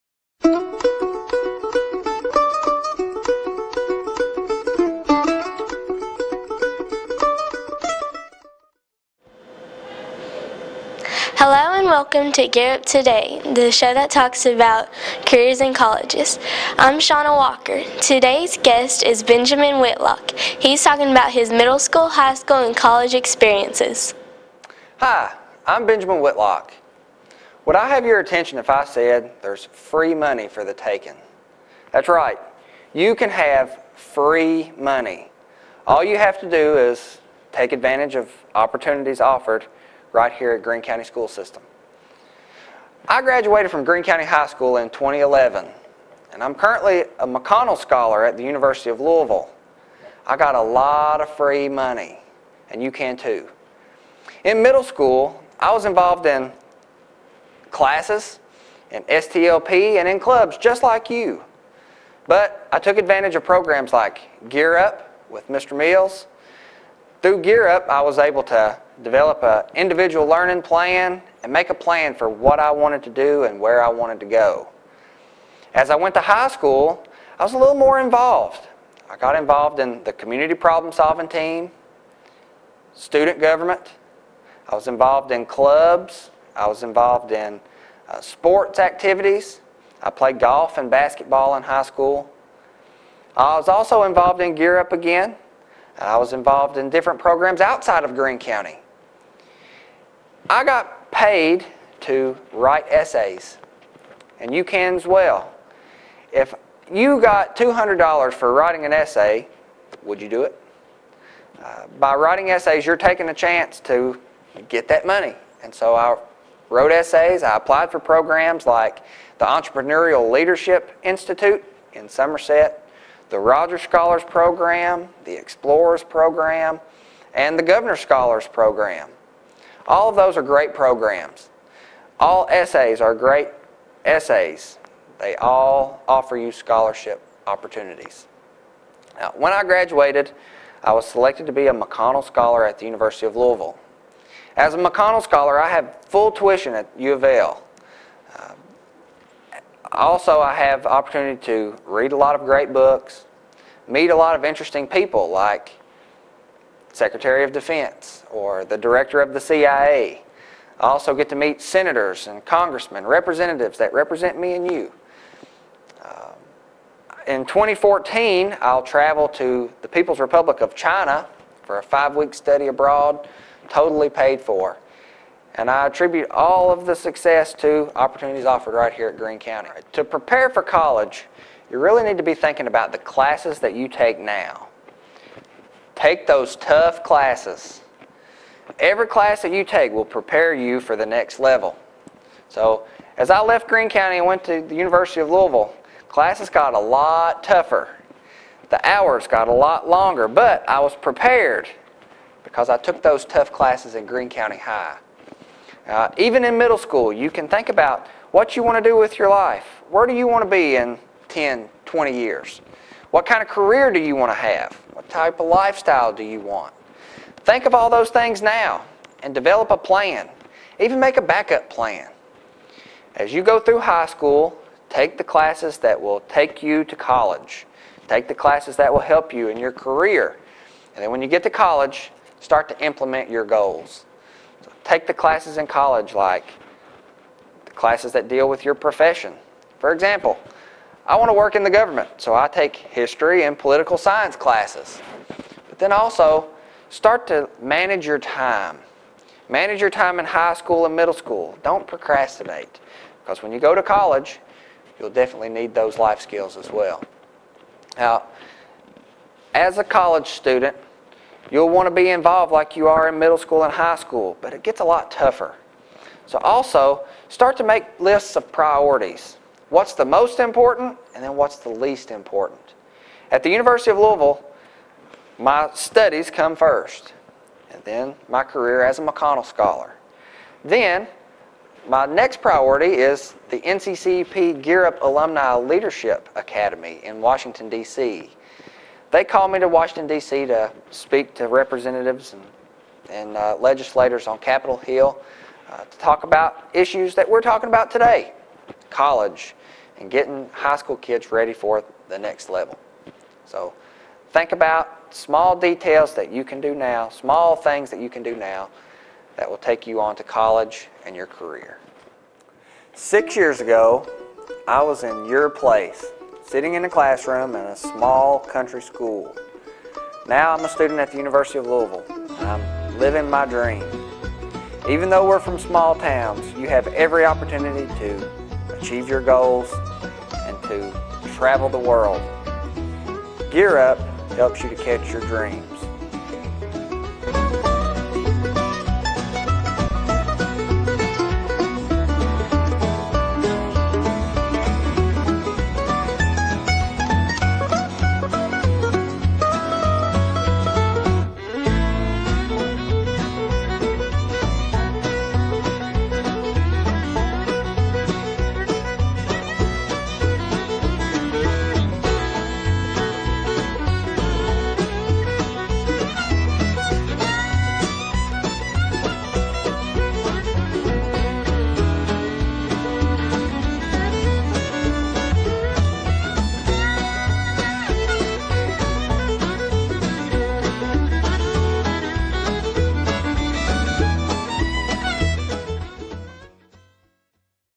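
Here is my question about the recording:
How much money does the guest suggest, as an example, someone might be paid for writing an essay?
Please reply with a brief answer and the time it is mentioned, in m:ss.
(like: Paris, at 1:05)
$200, at 1:47.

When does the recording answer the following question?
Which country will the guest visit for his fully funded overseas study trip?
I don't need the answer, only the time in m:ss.
2:49.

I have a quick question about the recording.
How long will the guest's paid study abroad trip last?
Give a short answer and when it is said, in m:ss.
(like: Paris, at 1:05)
5 weeks, at 2:51.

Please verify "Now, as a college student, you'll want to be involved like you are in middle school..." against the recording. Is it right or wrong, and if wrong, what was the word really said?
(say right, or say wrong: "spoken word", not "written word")
right.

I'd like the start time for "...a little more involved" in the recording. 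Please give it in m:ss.
1:17.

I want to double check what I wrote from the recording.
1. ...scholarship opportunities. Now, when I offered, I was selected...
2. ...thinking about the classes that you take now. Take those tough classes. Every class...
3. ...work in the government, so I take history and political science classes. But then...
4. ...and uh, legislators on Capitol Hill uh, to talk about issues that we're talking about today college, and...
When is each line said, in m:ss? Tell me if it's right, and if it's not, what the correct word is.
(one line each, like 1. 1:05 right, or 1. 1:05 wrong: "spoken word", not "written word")
1. 2:16 wrong: "graduated", not "offered"
2. 3:02 right
3. 4:01 right
4. 4:53 right.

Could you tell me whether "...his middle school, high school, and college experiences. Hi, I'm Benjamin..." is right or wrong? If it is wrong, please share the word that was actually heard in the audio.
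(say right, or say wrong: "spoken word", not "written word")
right.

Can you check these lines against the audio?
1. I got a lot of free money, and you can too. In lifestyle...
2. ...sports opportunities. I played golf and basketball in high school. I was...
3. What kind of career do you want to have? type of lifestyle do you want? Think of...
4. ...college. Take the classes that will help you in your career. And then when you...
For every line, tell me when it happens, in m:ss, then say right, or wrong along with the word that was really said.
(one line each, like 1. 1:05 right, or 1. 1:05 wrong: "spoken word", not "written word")
1. 0:50 wrong: "middle", not "lifestyle"
2. 1:28 wrong: "activities", not "opportunities"
3. 3:33 right
4. 3:46 right.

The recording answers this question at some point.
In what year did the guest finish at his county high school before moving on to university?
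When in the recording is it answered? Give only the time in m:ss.
0:44.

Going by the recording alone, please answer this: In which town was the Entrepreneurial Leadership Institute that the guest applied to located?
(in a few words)
Somerset.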